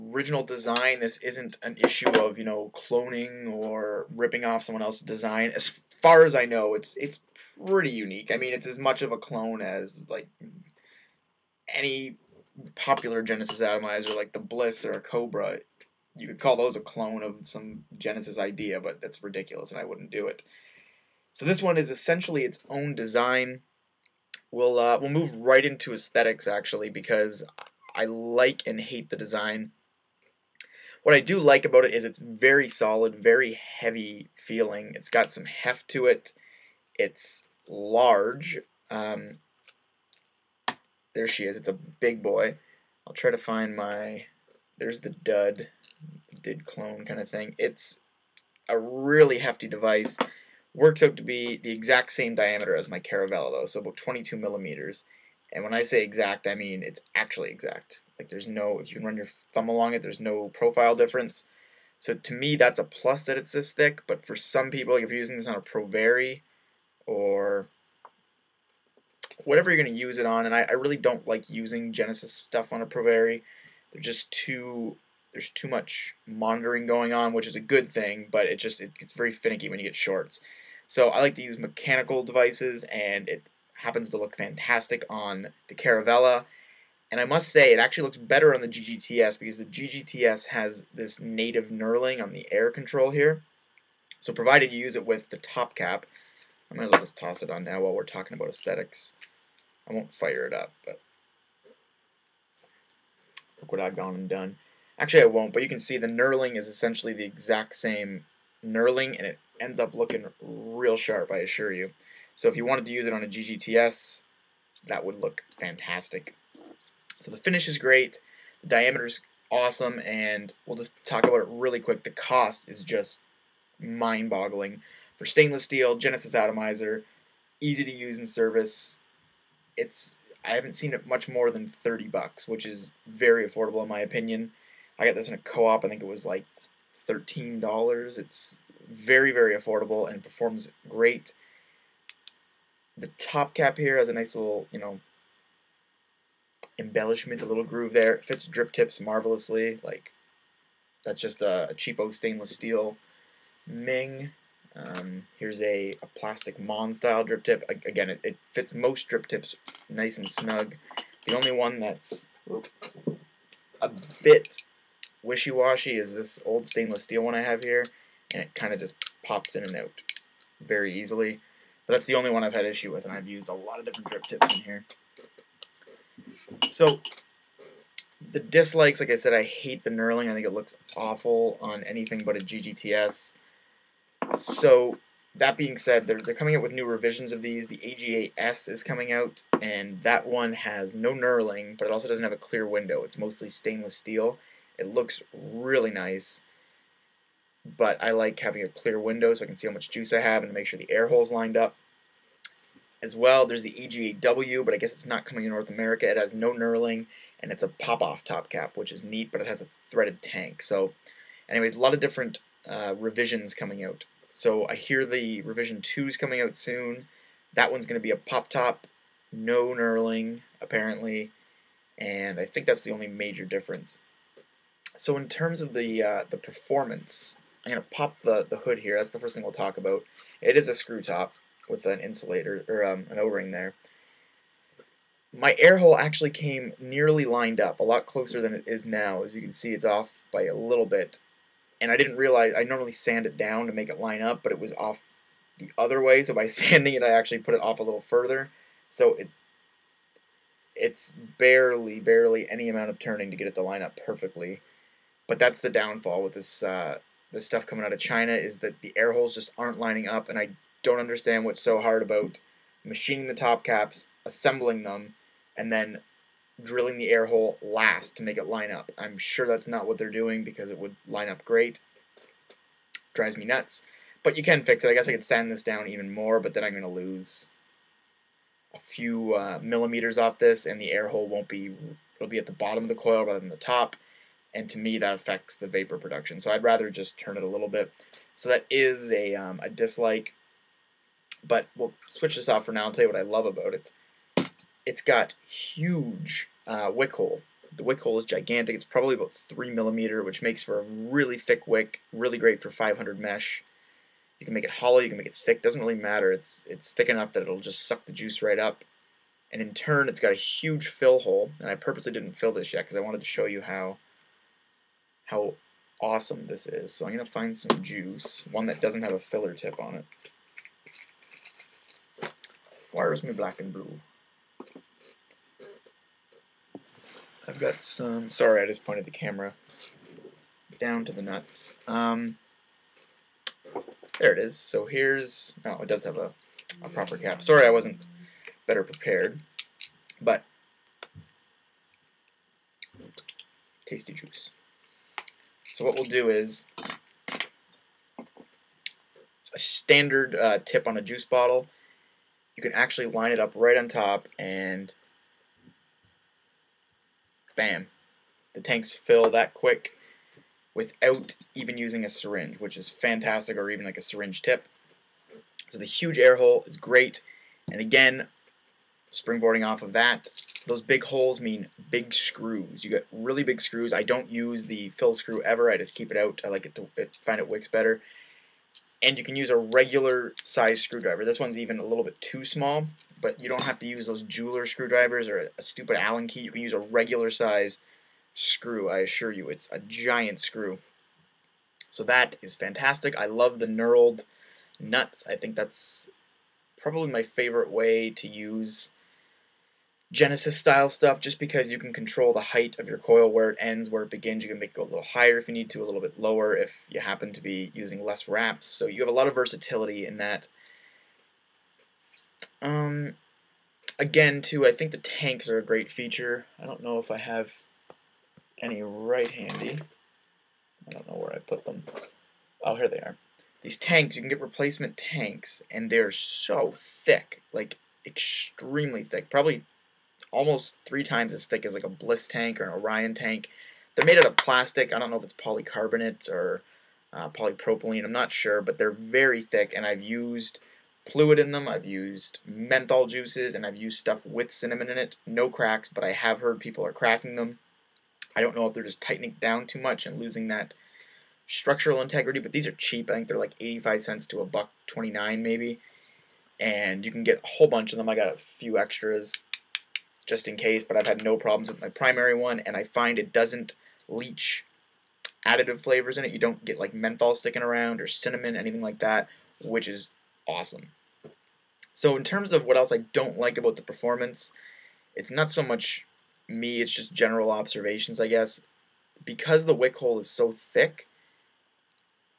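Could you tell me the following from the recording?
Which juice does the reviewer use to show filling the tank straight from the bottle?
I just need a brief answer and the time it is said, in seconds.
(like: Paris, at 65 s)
black and blue, at 323 s.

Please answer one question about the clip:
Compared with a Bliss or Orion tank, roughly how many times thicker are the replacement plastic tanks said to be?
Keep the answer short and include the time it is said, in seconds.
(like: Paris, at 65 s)
3 times, at 430 s.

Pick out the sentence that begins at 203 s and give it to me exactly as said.
There's the AGA-W, but I guess it's not coming to North America.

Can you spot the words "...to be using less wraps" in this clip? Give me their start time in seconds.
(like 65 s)
407 s.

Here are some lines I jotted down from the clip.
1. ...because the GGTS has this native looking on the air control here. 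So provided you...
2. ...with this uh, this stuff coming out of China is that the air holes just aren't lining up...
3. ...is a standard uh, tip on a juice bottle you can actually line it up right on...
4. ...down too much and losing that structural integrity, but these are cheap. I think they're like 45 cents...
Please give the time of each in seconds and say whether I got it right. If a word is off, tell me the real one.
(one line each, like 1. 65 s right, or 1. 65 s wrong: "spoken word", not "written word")
1. 89 s wrong: "knurling", not "looking"
2. 256 s right
3. 346 s right
4. 449 s wrong: "85", not "45".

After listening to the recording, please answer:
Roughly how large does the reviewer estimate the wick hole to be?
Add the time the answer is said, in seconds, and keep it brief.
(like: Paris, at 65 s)
3 millimeter, at 299 s.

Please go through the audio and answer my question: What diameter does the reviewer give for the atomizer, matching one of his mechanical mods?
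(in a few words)
22 millimeters.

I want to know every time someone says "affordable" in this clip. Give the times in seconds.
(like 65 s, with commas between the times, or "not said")
133 s, 139 s.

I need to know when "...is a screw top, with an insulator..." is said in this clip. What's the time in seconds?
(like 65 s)
230 s.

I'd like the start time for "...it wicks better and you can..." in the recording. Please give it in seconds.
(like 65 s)
377 s.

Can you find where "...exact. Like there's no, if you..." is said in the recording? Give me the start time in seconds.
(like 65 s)
57 s.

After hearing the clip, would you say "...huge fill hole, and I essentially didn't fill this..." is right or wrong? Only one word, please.
wrong.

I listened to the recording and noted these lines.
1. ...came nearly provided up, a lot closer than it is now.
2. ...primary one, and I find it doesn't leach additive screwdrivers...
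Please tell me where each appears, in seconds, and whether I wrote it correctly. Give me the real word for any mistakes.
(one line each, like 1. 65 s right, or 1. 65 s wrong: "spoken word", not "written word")
1. 236 s wrong: "lined", not "provided"
2. 461 s wrong: "flavors", not "screwdrivers".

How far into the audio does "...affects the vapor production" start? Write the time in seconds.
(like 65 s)
285 s.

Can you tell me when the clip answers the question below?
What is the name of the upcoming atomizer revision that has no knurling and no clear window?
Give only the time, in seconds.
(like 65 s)
187 s.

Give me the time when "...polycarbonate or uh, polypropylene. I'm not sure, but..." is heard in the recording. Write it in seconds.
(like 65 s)
435 s.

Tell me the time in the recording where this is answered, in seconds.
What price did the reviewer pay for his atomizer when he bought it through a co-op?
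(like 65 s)
137 s.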